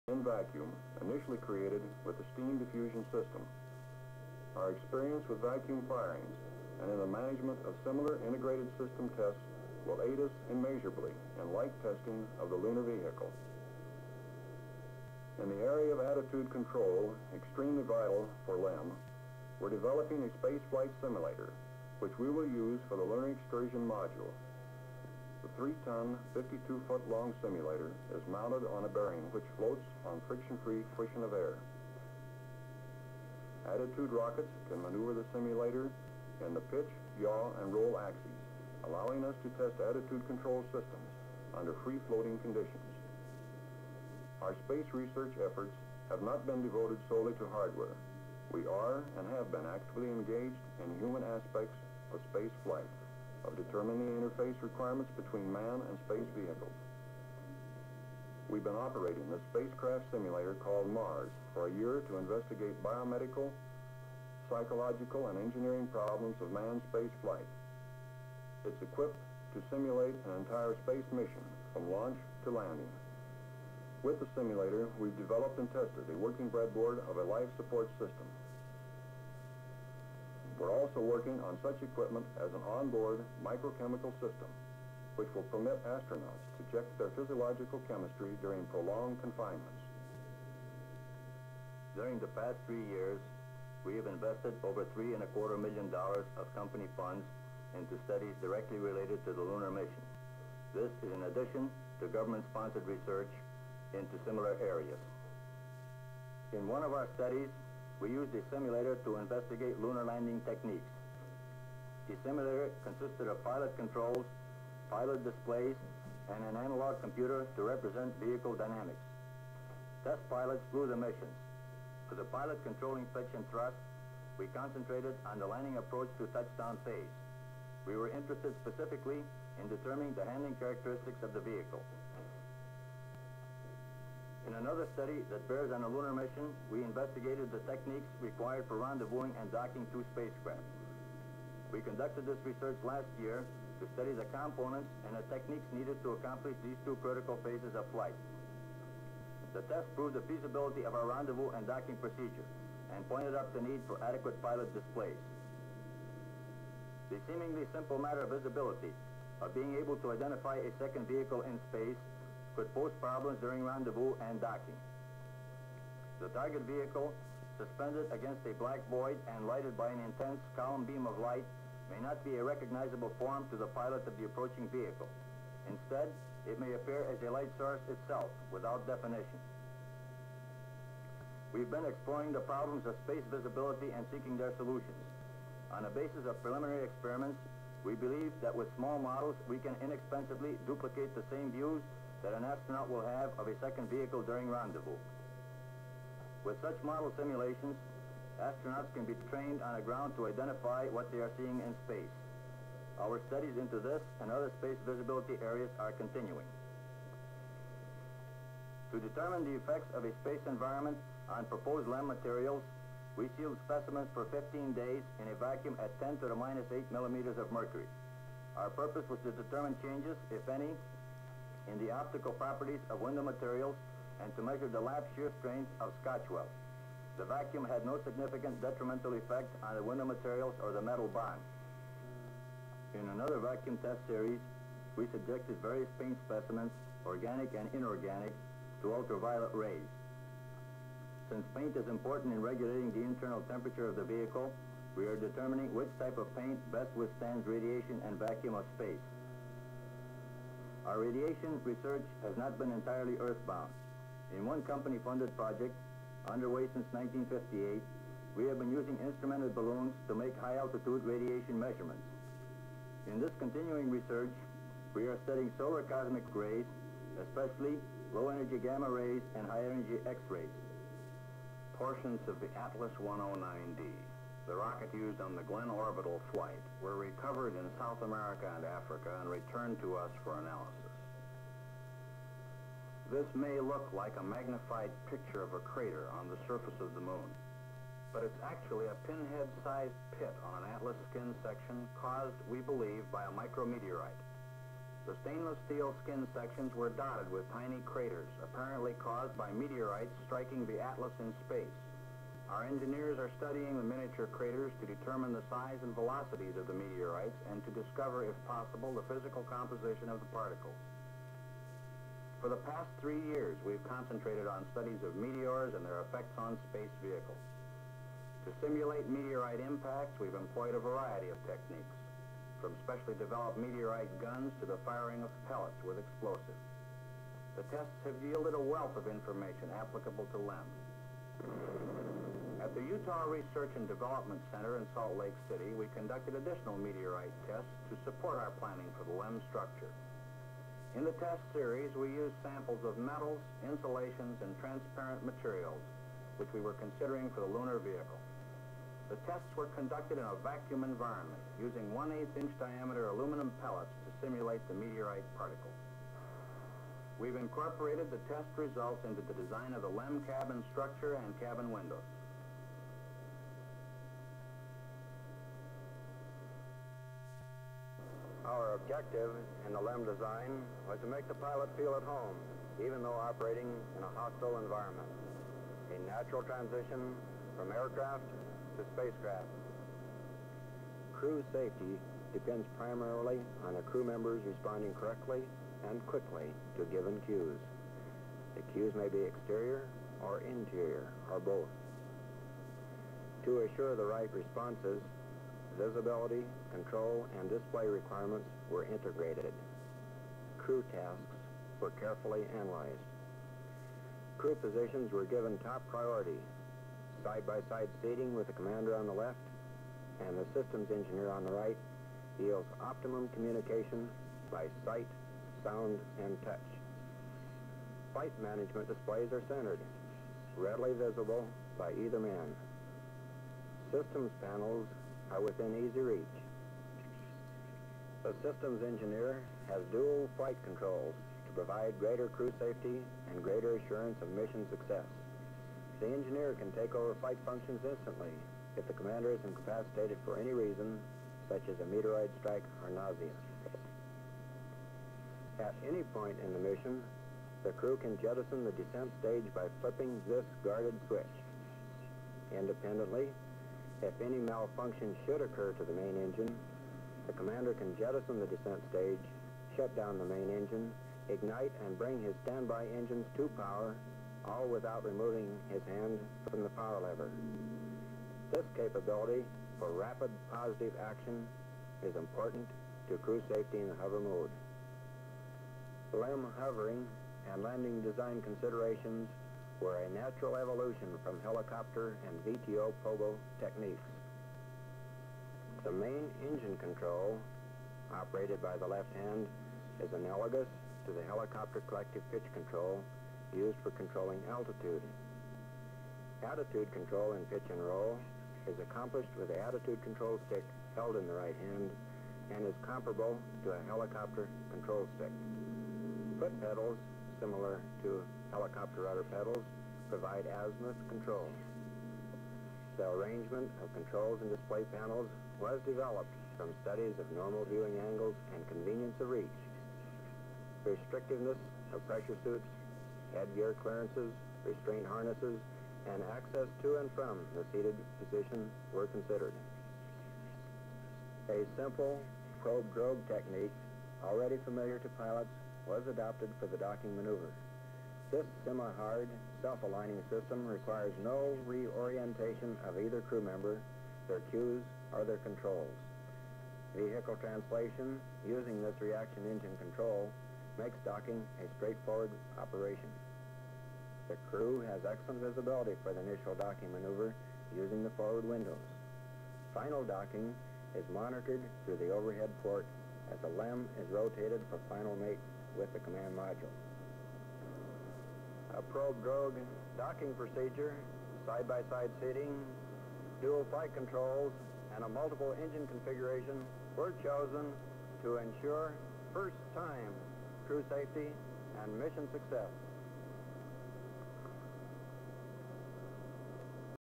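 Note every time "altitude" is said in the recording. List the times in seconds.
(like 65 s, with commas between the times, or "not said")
260 s, 494 s.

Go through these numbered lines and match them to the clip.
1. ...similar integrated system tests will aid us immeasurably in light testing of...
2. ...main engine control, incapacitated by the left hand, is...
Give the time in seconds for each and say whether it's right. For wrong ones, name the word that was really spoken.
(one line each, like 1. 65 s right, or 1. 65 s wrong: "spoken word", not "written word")
1. 7 s right
2. 485 s wrong: "operated", not "incapacitated".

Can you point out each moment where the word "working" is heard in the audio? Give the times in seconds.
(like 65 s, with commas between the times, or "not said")
76 s, 81 s.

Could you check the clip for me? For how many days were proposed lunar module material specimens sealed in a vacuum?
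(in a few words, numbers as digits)
15 days.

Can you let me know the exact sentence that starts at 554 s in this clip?
The crew has excellent visibility for the initial docking maneuver using the forward windows.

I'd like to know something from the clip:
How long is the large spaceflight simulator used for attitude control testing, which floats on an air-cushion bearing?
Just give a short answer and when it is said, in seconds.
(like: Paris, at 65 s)
52 feet, at 26 s.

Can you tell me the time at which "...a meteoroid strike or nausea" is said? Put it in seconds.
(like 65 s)
441 s.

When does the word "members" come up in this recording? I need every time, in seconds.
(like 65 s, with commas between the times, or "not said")
384 s, 543 s.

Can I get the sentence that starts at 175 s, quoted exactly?
Instead, it may appear as a light source itself, without definition.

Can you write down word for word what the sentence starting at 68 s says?
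It's equipped to simulate an entire space mission from launch to landing.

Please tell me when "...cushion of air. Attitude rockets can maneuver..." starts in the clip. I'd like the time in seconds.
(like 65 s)
30 s.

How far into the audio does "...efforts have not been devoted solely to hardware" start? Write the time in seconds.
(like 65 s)
45 s.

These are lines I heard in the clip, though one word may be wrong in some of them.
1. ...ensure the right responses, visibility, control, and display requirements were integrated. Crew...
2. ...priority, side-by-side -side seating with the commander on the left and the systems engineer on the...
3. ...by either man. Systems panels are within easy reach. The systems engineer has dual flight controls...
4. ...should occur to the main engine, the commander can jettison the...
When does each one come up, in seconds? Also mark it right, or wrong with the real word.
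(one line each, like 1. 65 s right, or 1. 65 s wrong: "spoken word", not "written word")
1. 393 s wrong: "assure", not "ensure"
2. 405 s right
3. 421 s right
4. 455 s right.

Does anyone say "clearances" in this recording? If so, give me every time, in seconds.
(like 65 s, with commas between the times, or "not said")
523 s.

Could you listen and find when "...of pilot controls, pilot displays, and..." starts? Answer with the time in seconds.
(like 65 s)
113 s.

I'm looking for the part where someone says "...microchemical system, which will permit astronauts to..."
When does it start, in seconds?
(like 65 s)
83 s.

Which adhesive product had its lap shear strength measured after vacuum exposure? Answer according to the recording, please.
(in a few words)
Scotch-Weld.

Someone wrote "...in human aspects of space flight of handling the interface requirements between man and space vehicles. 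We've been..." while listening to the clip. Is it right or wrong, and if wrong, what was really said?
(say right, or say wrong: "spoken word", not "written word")
wrong: "determining", not "handling".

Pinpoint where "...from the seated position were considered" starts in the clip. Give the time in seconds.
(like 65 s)
527 s.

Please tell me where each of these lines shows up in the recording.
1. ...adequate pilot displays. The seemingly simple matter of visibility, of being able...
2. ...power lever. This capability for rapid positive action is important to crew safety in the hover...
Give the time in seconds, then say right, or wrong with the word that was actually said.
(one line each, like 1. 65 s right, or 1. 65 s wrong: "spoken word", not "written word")
1. 154 s right
2. 466 s right.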